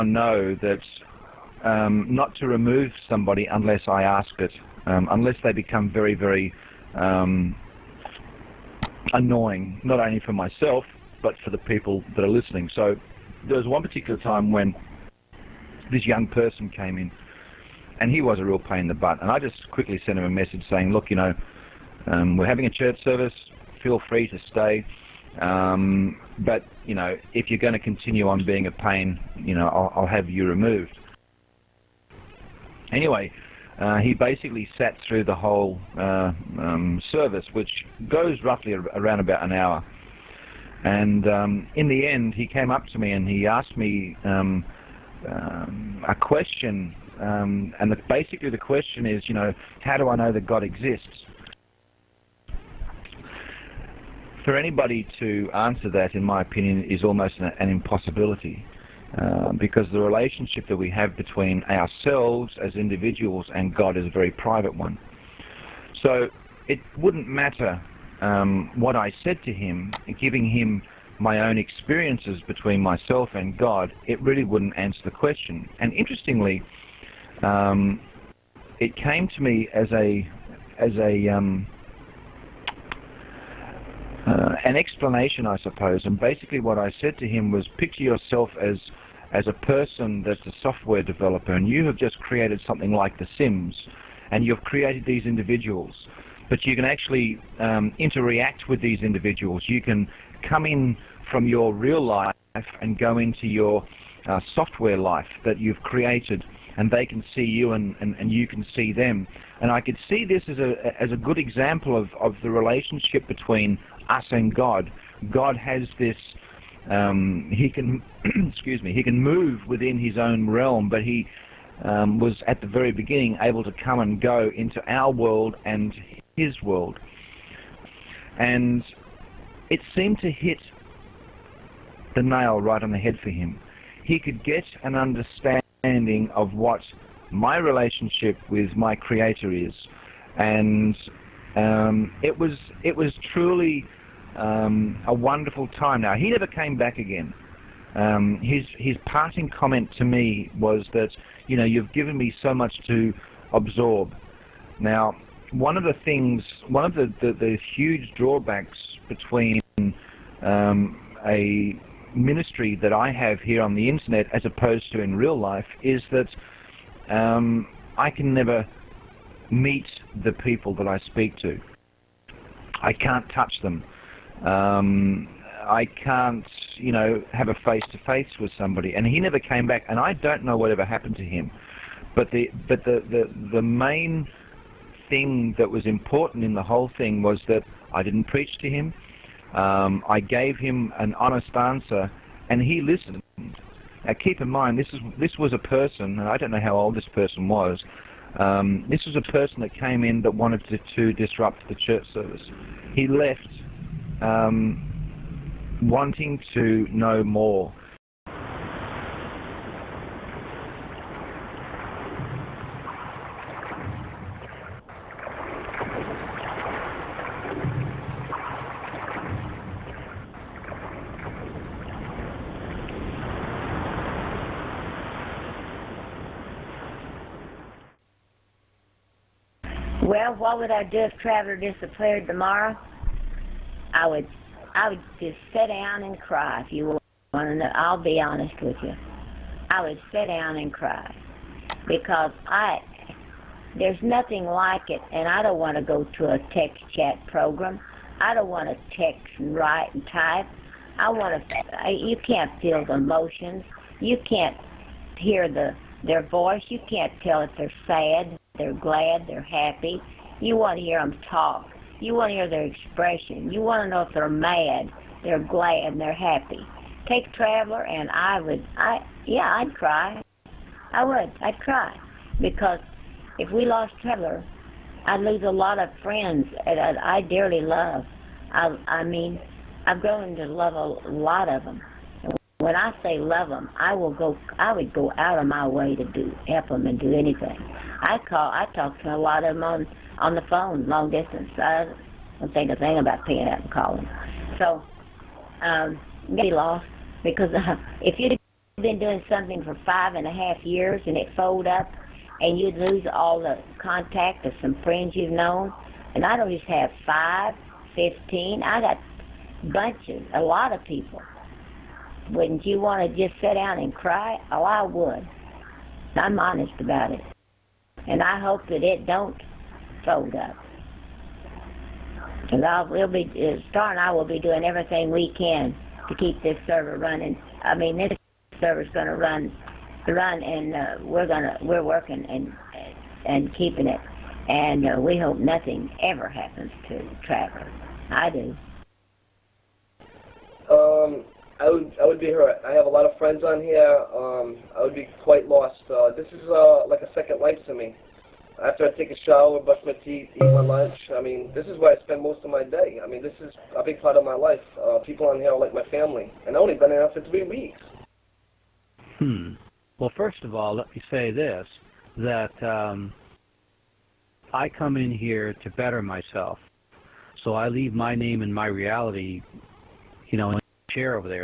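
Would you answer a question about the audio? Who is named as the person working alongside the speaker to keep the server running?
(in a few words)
Star.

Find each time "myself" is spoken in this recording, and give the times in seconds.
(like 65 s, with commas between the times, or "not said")
10 s, 72 s, 366 s.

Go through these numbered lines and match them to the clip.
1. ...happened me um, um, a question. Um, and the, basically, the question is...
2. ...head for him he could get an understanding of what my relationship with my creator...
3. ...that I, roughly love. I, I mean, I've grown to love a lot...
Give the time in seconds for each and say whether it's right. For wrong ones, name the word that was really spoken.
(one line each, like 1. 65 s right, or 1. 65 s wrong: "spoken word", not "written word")
1. 43 s wrong: "asked", not "happened"
2. 132 s right
3. 276 s wrong: "dearly", not "roughly".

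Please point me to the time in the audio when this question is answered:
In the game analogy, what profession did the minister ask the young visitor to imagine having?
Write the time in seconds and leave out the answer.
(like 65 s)
90 s.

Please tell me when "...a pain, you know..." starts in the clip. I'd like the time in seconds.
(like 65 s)
28 s.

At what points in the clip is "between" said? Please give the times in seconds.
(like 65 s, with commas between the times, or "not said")
61 s, 72 s, 113 s, 159 s.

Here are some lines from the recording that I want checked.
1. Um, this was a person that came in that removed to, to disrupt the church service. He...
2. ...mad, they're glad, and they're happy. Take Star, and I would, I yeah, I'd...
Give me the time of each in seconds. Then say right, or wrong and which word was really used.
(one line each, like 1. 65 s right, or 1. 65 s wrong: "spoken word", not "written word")
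1. 198 s wrong: "wanted", not "removed"
2. 264 s wrong: "Traveler", not "Star".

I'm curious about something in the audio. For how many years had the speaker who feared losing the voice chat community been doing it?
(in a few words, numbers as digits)
5 and a half years.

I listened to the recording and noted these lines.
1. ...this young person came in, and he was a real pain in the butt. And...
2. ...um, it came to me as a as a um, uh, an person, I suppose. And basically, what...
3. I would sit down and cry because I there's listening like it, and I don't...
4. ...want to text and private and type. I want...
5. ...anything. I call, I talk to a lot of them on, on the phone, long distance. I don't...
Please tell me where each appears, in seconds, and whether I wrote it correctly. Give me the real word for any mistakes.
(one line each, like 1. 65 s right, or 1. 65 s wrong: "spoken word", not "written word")
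1. 15 s right
2. 77 s wrong: "explanation", not "person"
3. 239 s wrong: "nothing", not "listening"
4. 248 s wrong: "write", not "private"
5. 287 s right.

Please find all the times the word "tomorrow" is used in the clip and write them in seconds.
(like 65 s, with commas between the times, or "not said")
232 s.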